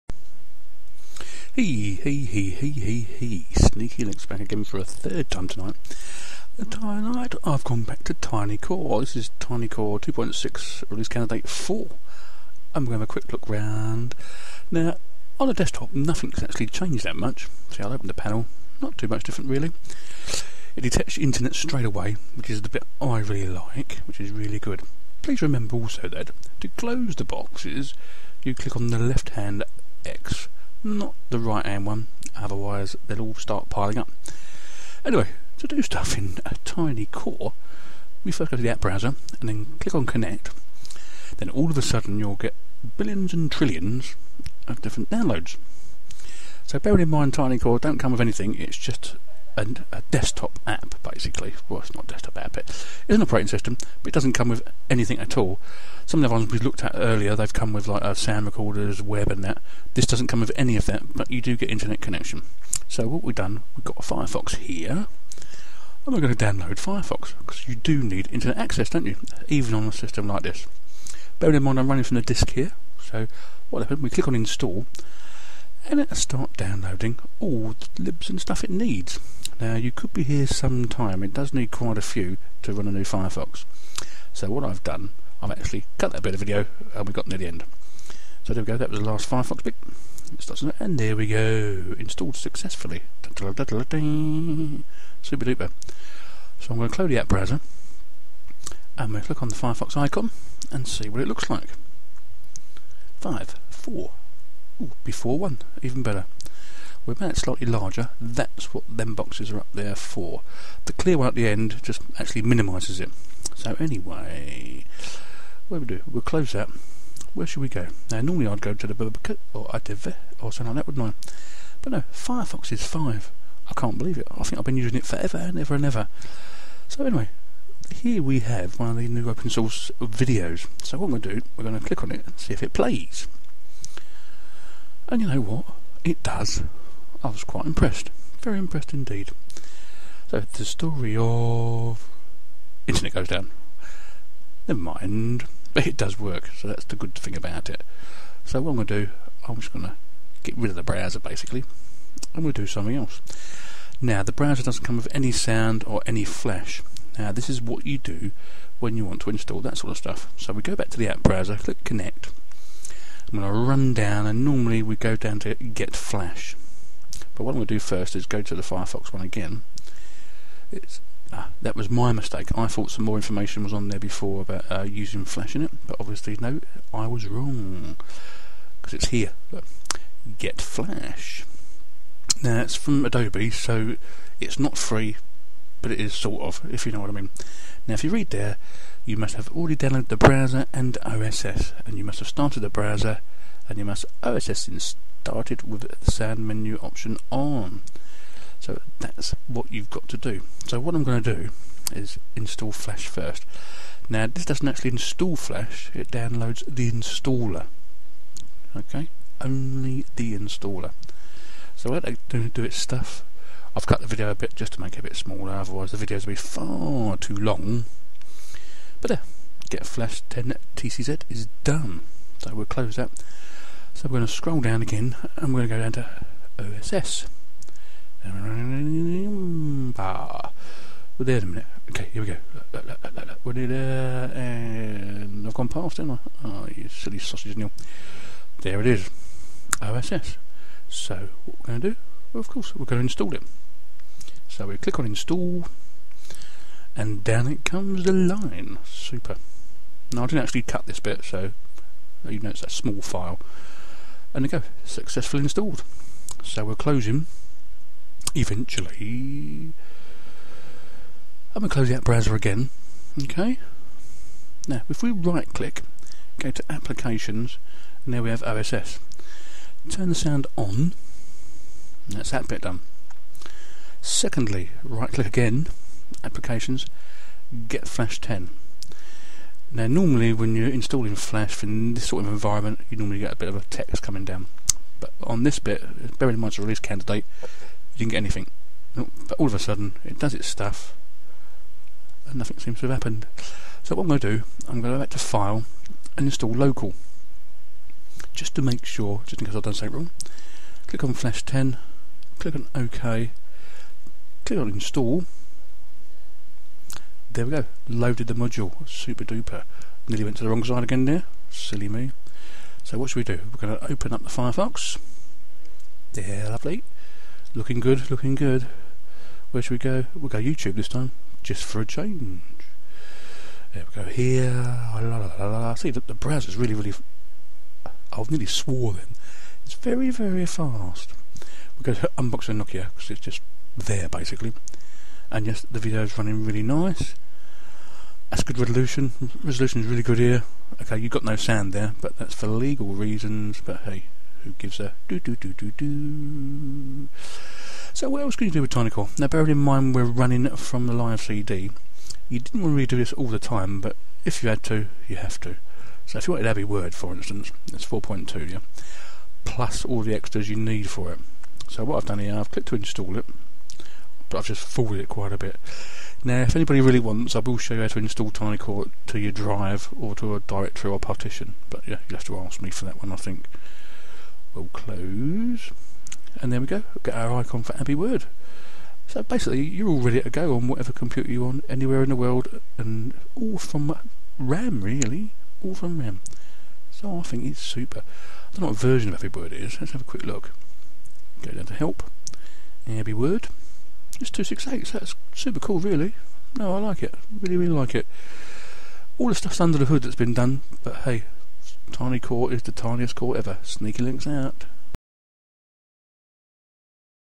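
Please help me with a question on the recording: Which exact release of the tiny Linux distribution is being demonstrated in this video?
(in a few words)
2.6 release candidate 4.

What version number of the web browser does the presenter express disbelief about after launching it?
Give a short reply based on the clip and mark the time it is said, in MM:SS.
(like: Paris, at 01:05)
5, at 02:02.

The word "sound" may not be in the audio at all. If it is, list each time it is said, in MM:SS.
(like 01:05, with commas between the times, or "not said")
00:58, 02:35, 03:16, 04:30, 05:41.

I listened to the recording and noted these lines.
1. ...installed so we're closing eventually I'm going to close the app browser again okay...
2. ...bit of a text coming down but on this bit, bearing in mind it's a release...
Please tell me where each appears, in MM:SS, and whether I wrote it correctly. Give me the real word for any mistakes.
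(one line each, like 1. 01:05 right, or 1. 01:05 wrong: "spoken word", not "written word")
1. 04:15 right
2. 04:43 right.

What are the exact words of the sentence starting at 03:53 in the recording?
we're near there and I've gone past, did not I?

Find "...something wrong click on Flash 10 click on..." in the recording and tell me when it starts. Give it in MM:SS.
04:59.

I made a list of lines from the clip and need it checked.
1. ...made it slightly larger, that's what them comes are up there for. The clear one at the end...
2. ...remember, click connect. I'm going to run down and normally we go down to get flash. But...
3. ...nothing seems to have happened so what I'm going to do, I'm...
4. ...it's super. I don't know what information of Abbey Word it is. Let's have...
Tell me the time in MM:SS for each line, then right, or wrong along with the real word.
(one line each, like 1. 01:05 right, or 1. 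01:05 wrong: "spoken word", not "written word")
1. 01:47 wrong: "boxes", not "comes"
2. 02:41 wrong: "browser", not "remember"
3. 04:52 right
4. 06:27 wrong: "version", not "information".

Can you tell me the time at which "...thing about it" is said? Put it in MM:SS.
02:27.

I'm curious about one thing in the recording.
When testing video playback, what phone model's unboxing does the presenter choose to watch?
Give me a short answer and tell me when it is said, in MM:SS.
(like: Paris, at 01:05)
Nokia, at 05:32.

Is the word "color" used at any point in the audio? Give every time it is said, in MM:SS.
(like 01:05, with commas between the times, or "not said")
not said.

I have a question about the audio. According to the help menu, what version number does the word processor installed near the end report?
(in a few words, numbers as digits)
268.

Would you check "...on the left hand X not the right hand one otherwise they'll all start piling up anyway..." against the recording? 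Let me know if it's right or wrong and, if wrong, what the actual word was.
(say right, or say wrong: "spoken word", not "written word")
right.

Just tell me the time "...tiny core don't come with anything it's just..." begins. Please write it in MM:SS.
00:47.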